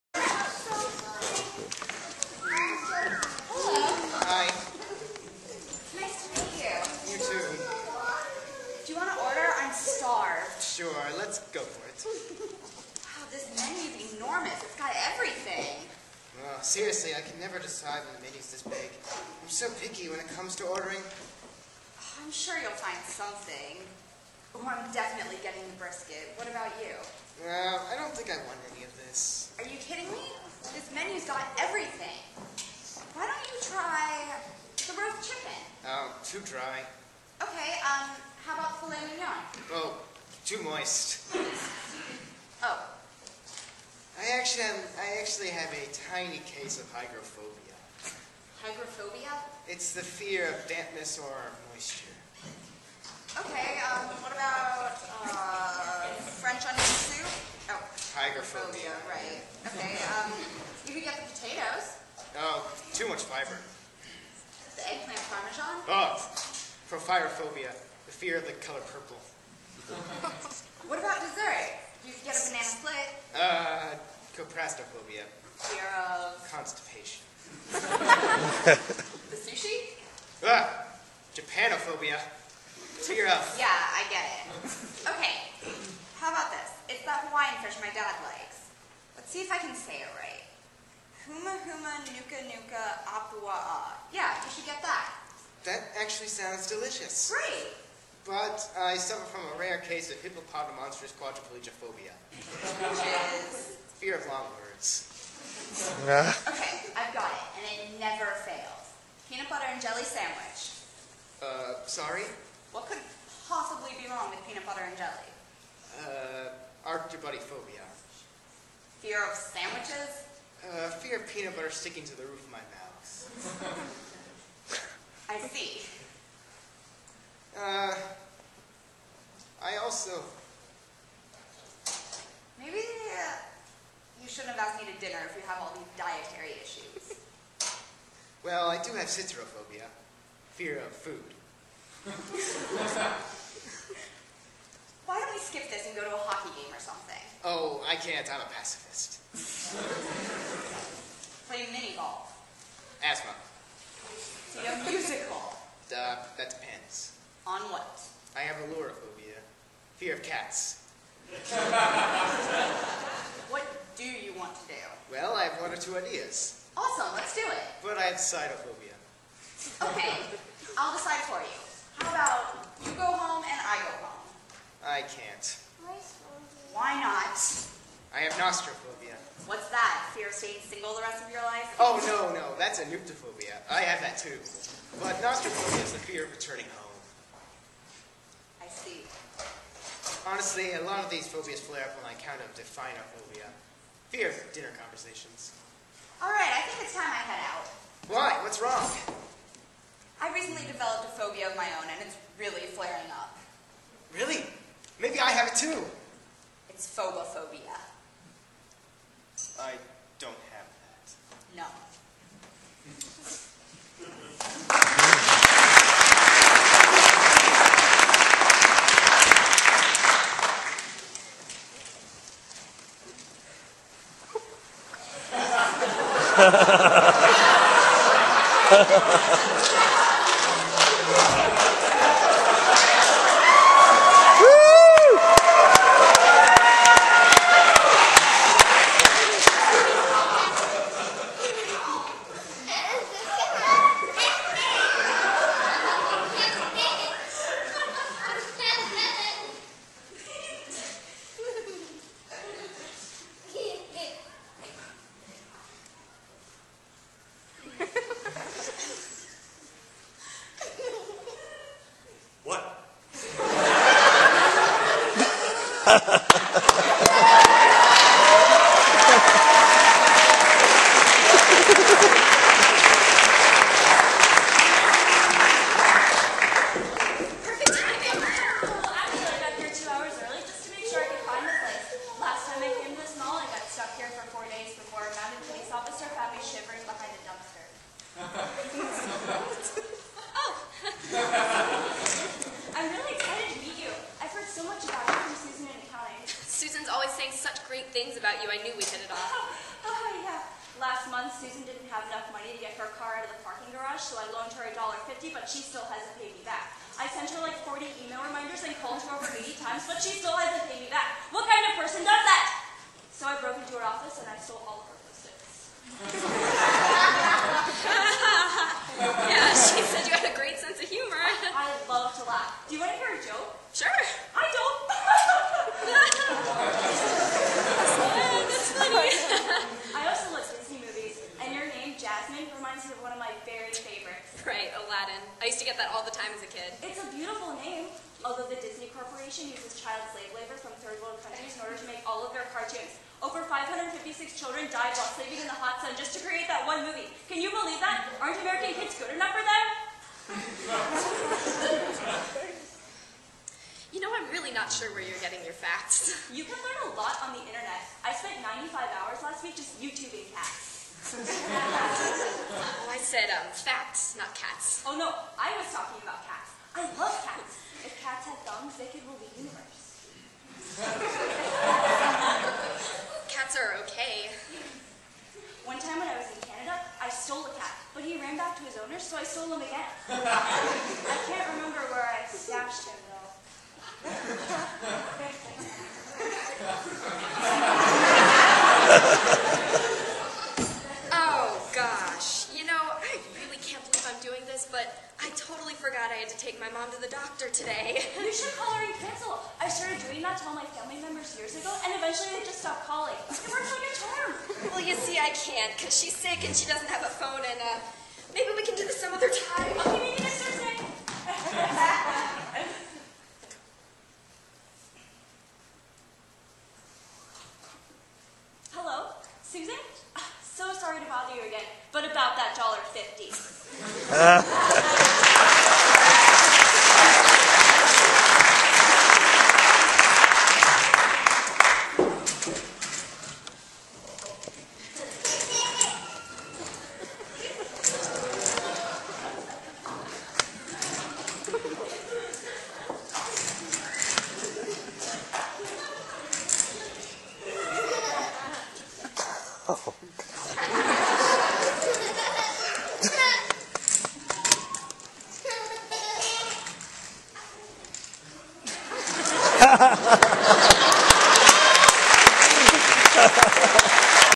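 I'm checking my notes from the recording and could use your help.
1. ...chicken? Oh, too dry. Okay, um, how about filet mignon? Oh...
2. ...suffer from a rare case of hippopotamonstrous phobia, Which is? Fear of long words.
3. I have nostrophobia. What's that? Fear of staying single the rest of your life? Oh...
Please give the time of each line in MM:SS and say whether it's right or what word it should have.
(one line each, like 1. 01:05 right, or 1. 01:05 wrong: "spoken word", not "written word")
1. 00:35 right
2. 01:38 right
3. 02:58 right.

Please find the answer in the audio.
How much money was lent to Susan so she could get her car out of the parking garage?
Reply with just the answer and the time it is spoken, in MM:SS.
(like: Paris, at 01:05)
$1.50, at 05:04.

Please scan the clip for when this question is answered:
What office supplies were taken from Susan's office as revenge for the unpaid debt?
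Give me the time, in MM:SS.
05:15.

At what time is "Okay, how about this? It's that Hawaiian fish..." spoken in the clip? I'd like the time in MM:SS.
01:25.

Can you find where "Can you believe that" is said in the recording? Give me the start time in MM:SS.
05:47.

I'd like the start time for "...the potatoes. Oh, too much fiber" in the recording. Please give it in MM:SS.
01:01.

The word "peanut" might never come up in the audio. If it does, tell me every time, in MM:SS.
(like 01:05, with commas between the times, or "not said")
01:49, 01:54, 02:01.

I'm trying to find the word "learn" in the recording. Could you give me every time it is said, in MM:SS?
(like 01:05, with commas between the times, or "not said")
05:56.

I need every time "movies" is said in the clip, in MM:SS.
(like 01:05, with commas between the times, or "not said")
05:30, 05:46.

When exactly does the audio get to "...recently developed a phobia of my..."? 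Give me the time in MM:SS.
03:20.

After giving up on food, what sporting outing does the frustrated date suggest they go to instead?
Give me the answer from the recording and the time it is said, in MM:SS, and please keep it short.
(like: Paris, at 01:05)
a hockey game, at 02:26.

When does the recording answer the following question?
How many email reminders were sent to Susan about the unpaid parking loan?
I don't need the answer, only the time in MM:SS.
05:07.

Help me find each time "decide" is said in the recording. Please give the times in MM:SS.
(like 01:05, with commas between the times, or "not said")
00:17, 02:50.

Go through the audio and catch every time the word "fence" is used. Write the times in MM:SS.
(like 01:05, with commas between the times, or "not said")
not said.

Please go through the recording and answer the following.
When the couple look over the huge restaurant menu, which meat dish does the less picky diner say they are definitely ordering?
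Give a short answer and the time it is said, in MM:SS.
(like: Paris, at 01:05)
brisket, at 00:25.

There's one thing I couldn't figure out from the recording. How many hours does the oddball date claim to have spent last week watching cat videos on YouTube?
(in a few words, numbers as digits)
95.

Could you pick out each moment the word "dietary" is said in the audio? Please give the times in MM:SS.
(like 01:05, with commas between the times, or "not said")
02:15.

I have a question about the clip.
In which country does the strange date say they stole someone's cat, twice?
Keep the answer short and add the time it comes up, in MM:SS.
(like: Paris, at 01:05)
Canada, at 06:16.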